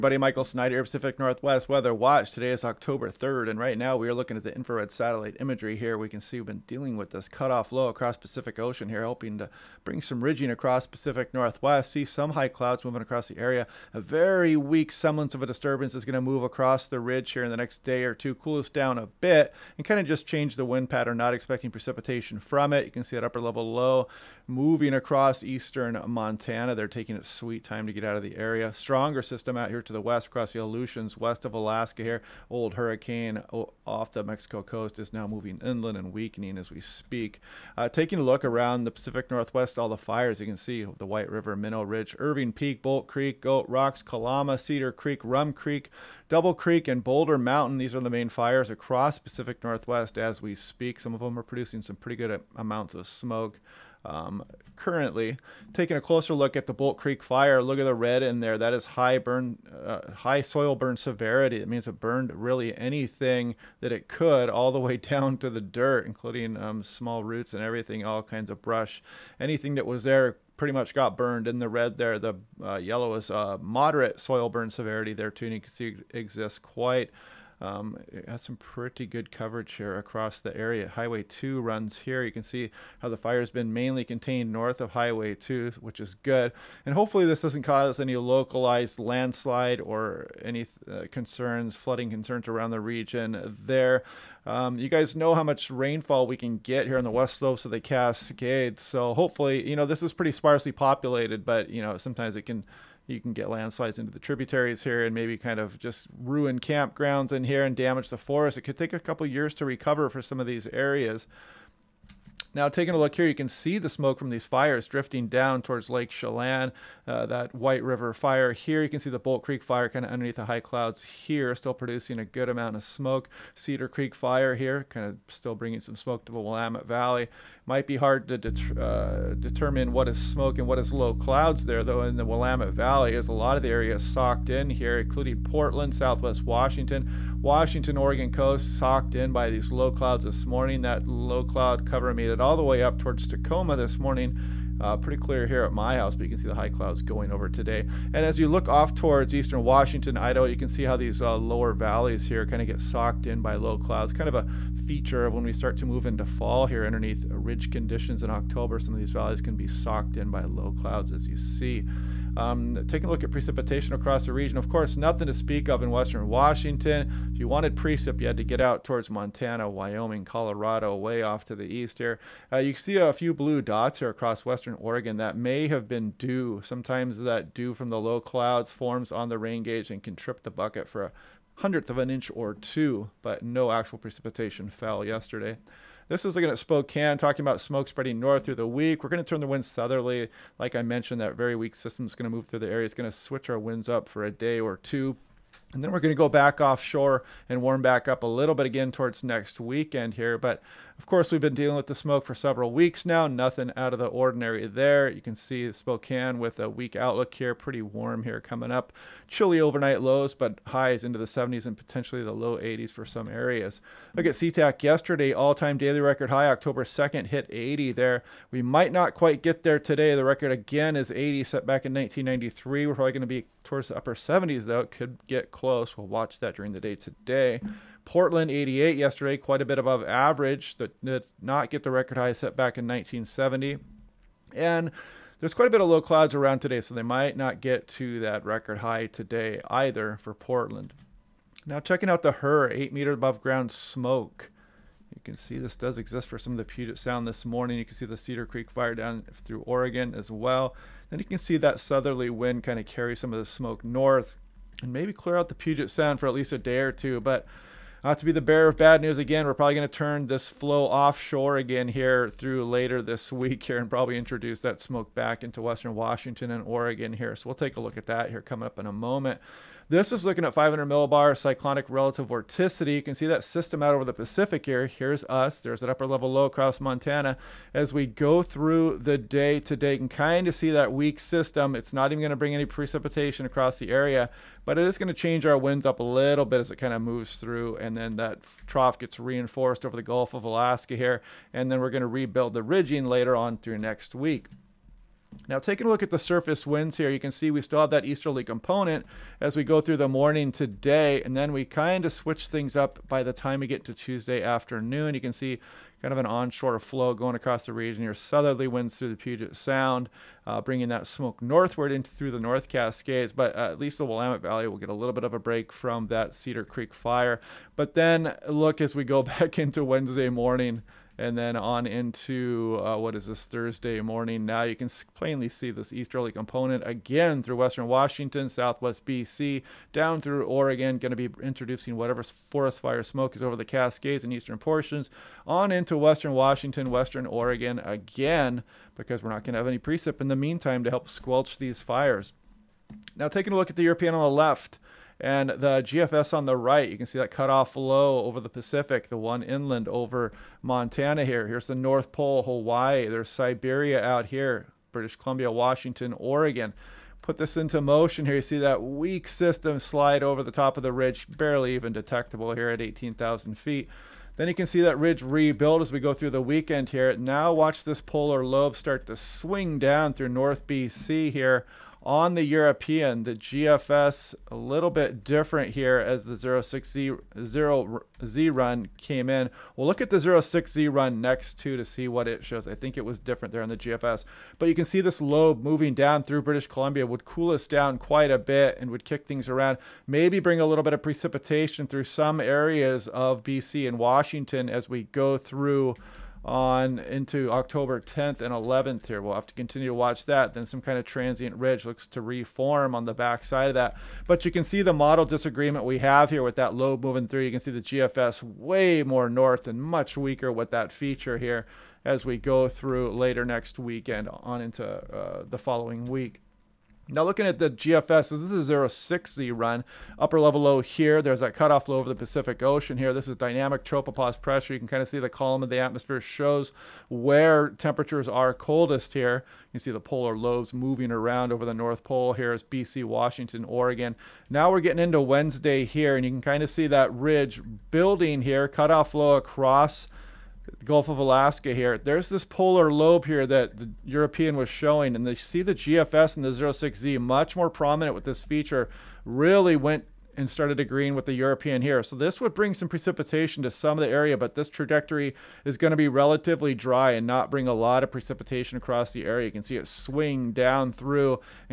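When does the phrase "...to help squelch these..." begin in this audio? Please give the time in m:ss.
5:40.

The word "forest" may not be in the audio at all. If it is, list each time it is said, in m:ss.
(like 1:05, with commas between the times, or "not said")
1:48, 5:32.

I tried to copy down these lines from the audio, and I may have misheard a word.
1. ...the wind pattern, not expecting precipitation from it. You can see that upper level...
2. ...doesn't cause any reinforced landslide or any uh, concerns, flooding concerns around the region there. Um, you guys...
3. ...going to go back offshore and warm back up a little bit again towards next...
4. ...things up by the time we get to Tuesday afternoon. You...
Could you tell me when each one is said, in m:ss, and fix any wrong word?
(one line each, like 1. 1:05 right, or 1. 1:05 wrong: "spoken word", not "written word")
1. 0:20 right
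2. 1:27 wrong: "localized", not "reinforced"
3. 3:15 right
4. 5:02 right.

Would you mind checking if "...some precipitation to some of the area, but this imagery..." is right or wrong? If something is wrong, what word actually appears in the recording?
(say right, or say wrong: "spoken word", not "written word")
wrong: "trajectory", not "imagery".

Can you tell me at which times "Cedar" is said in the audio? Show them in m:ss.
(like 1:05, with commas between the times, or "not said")
0:44, 2:03, 4:08, 5:16.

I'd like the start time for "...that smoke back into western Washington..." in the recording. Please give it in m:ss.
4:24.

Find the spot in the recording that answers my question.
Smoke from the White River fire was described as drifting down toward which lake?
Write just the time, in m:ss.
1:55.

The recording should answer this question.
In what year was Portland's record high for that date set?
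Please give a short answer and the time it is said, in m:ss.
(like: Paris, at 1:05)
1970, at 3:52.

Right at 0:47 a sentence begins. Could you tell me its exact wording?
These are the main fires across Pacific Northwest as we speak.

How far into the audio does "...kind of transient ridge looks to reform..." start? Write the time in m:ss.
6:40.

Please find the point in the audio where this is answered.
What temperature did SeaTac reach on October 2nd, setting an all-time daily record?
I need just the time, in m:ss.
3:37.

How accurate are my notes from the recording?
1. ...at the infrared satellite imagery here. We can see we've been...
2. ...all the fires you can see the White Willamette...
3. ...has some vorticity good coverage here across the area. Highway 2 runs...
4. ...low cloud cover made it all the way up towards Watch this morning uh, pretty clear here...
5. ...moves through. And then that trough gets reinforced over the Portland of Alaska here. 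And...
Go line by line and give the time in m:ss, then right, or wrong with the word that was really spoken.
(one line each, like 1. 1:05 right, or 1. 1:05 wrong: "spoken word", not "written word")
1. 0:04 right
2. 0:39 wrong: "River", not "Willamette"
3. 1:18 wrong: "pretty", not "vorticity"
4. 2:21 wrong: "Tacoma", not "Watch"
5. 4:47 wrong: "Gulf", not "Portland".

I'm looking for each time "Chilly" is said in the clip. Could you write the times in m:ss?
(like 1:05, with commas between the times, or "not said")
3:29.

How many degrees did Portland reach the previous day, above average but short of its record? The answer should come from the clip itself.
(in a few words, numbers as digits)
88.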